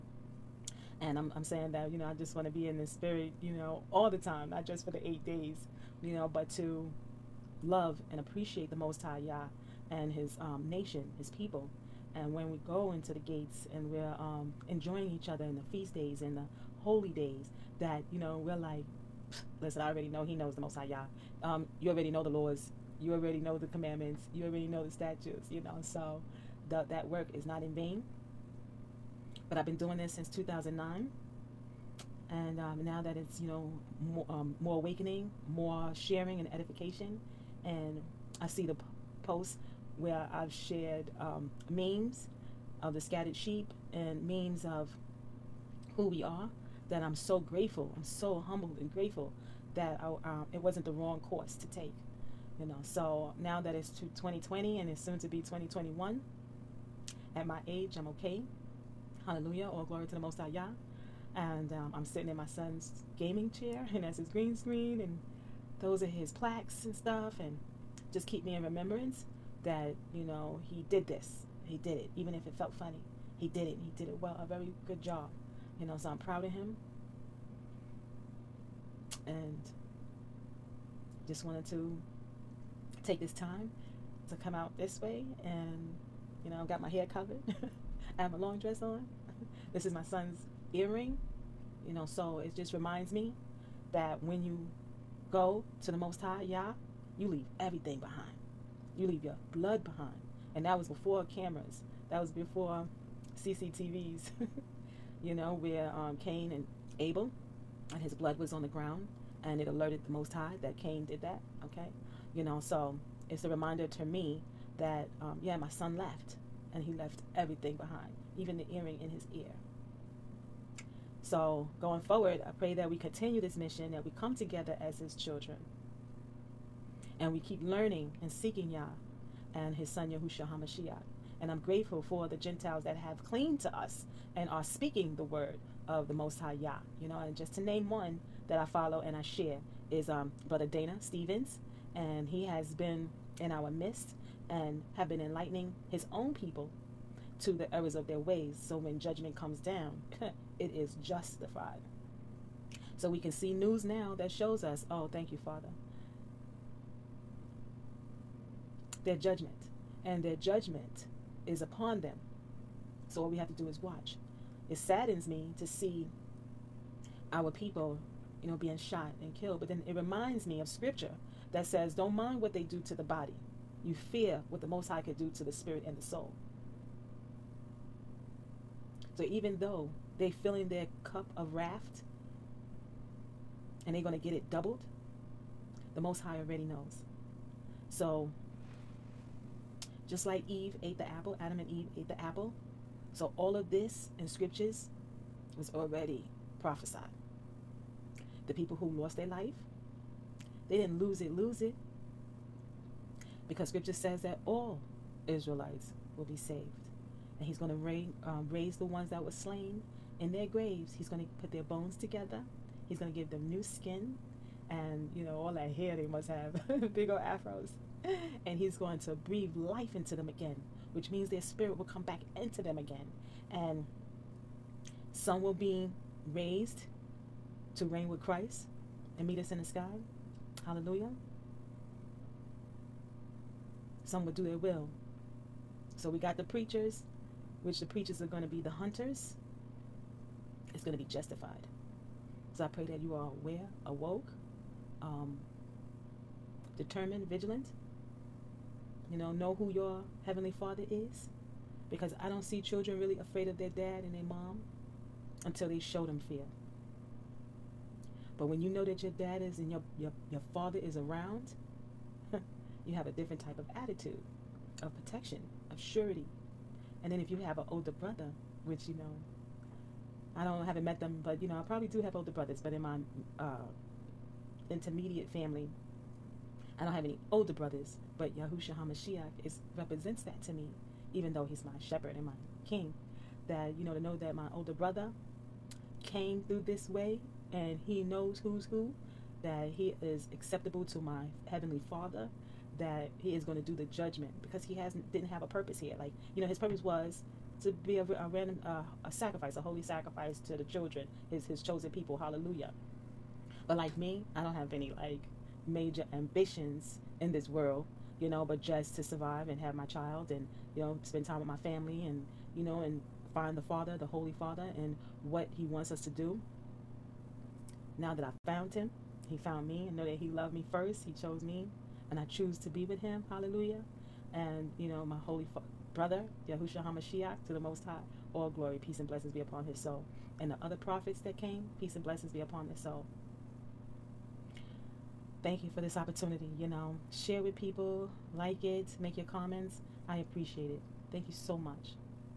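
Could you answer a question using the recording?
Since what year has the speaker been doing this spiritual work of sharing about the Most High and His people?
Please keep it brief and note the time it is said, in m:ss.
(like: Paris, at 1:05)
2009, at 0:30.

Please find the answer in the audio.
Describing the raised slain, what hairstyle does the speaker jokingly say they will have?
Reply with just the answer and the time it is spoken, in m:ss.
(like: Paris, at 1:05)
Big old afros, at 3:36.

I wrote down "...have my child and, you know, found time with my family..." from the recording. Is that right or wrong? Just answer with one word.
wrong.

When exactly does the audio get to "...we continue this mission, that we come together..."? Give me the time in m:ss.
2:02.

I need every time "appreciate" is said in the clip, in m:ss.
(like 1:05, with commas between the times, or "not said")
0:08, 5:40.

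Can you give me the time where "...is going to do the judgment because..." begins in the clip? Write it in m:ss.
4:53.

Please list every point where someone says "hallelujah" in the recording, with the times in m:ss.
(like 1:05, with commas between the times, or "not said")
0:59, 3:50, 5:02, 5:23.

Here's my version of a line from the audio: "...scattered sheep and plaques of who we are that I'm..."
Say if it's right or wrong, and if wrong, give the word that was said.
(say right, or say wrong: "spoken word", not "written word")
wrong: "memes", not "plaques".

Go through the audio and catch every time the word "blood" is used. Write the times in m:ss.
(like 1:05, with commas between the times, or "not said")
1:39, 1:48.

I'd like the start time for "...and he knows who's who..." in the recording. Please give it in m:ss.
4:47.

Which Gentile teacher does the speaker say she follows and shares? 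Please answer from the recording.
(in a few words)
Brother Dana Stevens.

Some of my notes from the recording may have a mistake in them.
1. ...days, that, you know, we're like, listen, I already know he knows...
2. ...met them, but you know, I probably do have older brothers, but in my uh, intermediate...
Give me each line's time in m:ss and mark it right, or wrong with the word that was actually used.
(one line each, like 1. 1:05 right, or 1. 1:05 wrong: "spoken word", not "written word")
1. 0:17 right
2. 4:30 right.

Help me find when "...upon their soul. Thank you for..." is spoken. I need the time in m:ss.
5:32.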